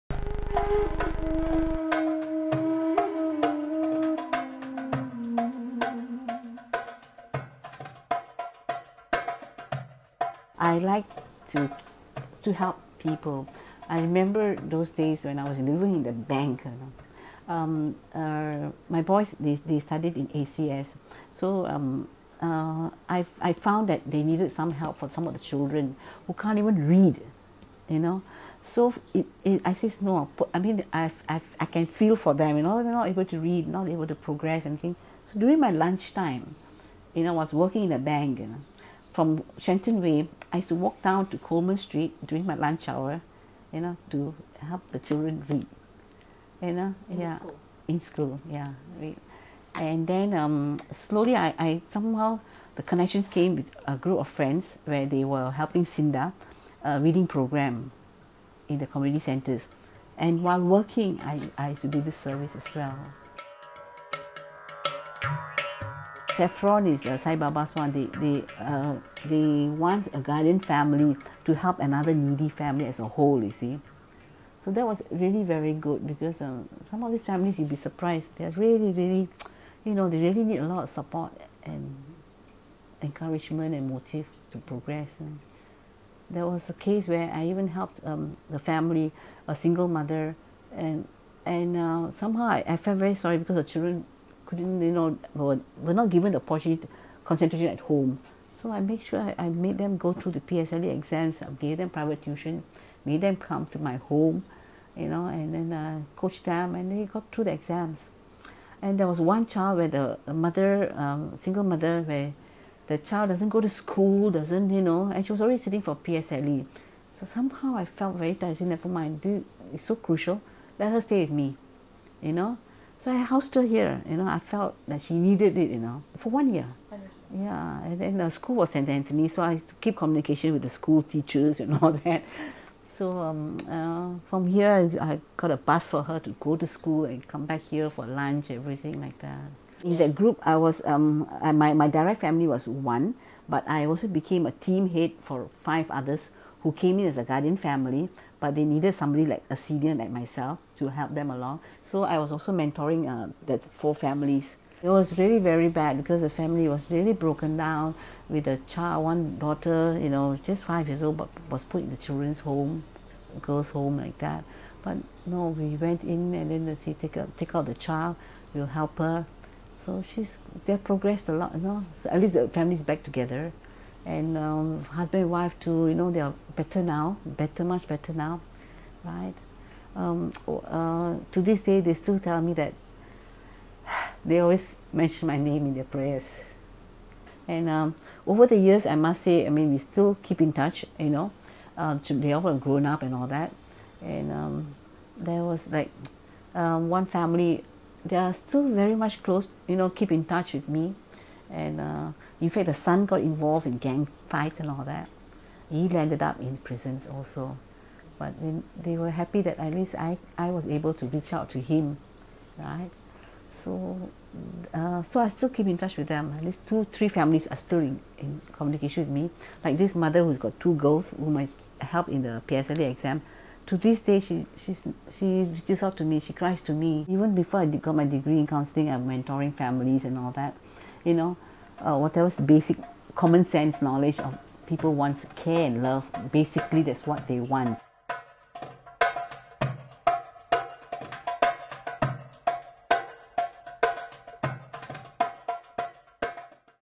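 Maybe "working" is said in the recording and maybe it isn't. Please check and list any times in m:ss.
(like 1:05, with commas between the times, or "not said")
0:37, 1:00.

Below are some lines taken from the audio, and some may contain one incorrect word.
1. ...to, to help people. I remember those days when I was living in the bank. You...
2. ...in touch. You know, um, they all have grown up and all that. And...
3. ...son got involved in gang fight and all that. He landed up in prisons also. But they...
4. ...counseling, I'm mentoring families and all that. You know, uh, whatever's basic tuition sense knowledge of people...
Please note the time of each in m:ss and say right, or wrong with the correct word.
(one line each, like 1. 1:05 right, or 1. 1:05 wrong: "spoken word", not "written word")
1. 0:11 right
2. 3:10 right
3. 3:22 right
4. 3:48 wrong: "common", not "tuition".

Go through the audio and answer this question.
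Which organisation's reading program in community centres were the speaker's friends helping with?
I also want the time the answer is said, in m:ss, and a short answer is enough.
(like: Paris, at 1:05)
SINDA, at 0:55.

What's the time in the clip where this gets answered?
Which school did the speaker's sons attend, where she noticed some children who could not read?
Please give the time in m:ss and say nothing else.
0:20.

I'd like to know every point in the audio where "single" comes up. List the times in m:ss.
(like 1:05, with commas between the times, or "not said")
1:29, 1:51.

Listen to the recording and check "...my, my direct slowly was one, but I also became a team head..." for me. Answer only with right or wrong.
wrong.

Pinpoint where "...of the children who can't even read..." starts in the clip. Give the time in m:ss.
0:25.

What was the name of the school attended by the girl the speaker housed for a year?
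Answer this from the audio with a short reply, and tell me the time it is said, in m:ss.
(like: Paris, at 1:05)
St. Anthony, at 2:08.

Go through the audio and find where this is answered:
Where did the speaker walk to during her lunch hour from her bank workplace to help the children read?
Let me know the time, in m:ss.
0:41.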